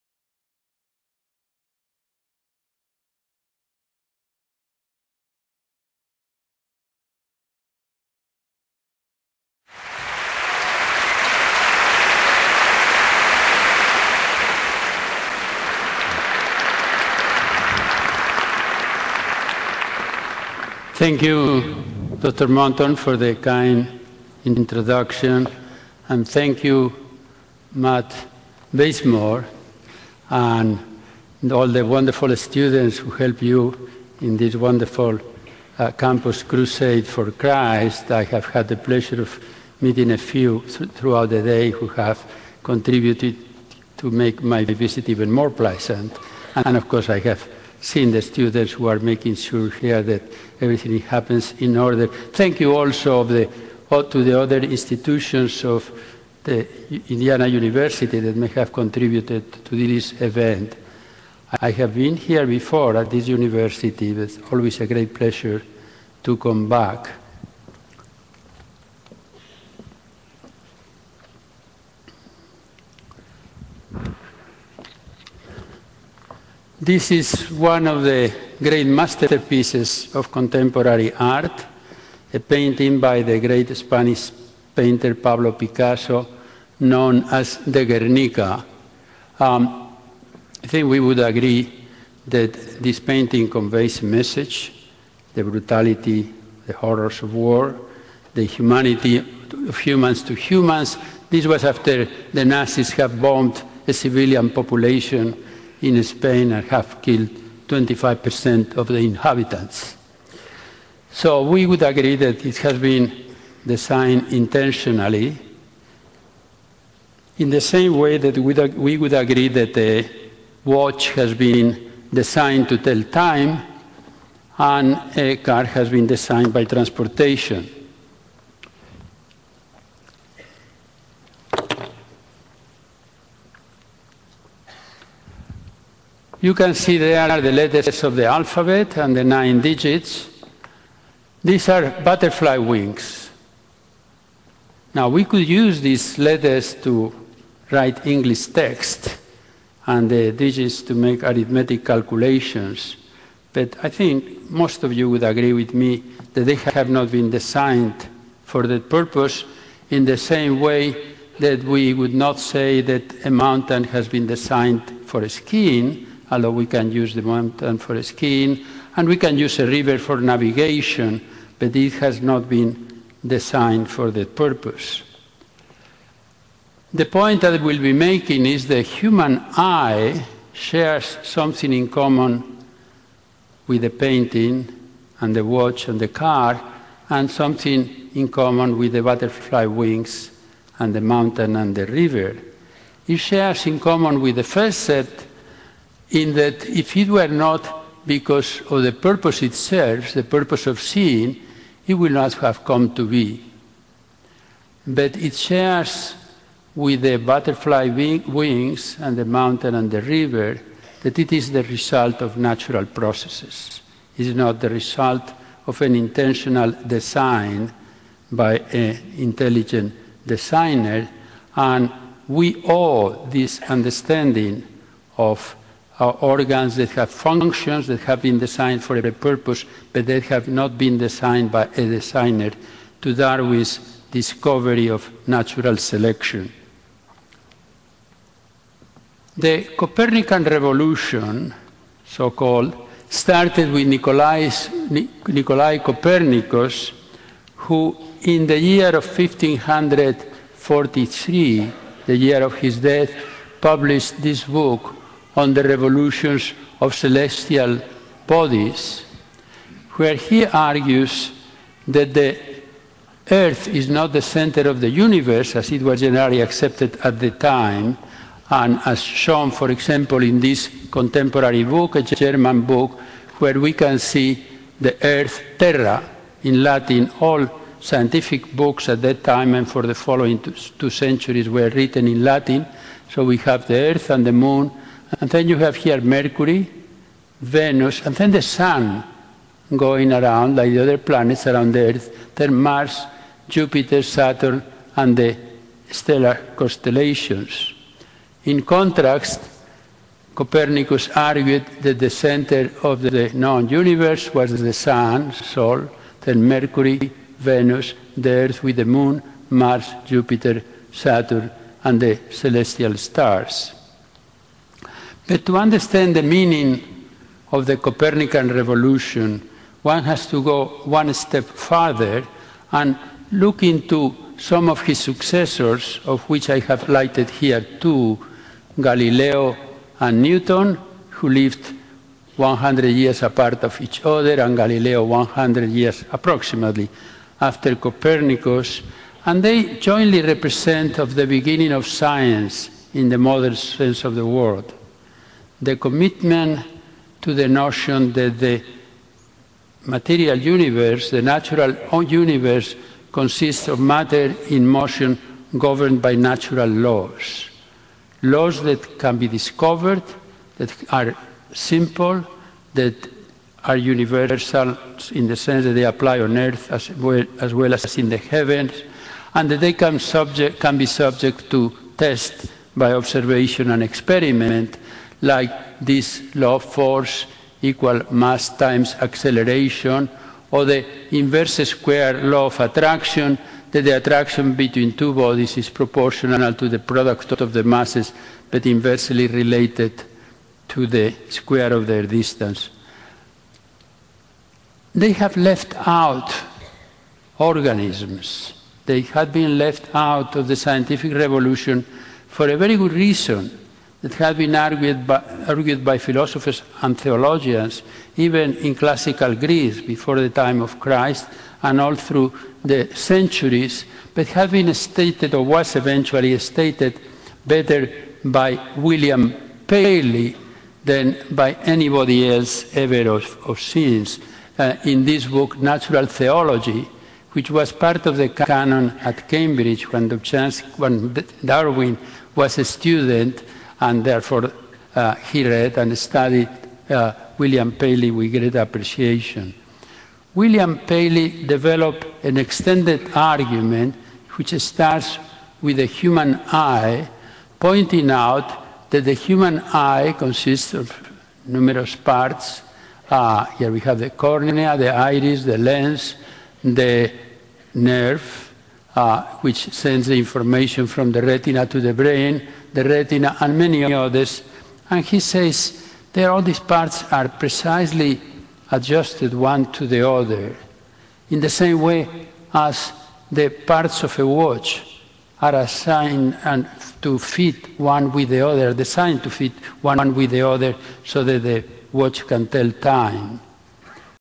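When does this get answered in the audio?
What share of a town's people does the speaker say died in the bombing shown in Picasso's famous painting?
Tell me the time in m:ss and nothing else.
1:47.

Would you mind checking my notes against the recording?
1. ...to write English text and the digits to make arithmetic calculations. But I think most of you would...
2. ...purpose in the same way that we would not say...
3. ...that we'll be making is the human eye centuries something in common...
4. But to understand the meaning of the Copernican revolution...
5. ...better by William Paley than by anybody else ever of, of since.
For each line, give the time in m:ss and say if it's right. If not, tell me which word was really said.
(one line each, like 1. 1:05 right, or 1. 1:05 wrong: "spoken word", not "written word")
1. 2:26 right
2. 2:38 right
3. 2:57 wrong: "shares", not "centuries"
4. 5:15 right
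5. 6:57 right.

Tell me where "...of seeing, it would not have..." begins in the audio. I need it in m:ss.
3:20.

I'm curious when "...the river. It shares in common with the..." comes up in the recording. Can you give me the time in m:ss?
3:11.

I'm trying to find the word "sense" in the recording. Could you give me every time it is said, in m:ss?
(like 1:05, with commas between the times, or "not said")
5:43, 6:05.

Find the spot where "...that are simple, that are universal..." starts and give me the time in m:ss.
6:00.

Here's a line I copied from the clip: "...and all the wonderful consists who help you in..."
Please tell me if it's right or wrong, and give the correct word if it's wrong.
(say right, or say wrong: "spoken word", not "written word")
wrong: "students", not "consists".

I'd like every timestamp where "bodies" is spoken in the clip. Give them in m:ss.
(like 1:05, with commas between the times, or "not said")
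4:18, 6:25.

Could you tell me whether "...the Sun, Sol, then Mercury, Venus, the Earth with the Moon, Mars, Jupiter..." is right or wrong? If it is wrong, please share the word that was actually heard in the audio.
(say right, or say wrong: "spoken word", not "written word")
right.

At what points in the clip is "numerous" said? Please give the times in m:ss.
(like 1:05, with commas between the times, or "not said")
7:31.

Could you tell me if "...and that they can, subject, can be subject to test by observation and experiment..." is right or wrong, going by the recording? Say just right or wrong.
right.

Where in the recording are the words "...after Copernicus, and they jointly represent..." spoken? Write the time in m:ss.
5:37.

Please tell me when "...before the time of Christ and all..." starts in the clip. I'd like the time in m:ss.
6:49.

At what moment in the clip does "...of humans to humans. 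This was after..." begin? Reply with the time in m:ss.
1:39.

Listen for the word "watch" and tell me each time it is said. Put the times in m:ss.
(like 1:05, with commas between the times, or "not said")
2:00, 3:05, 7:54, 8:01.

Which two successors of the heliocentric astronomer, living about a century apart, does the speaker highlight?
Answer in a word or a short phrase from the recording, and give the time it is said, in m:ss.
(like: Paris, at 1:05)
Galileo and Newton, at 5:28.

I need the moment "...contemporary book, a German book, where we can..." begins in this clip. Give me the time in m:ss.
4:30.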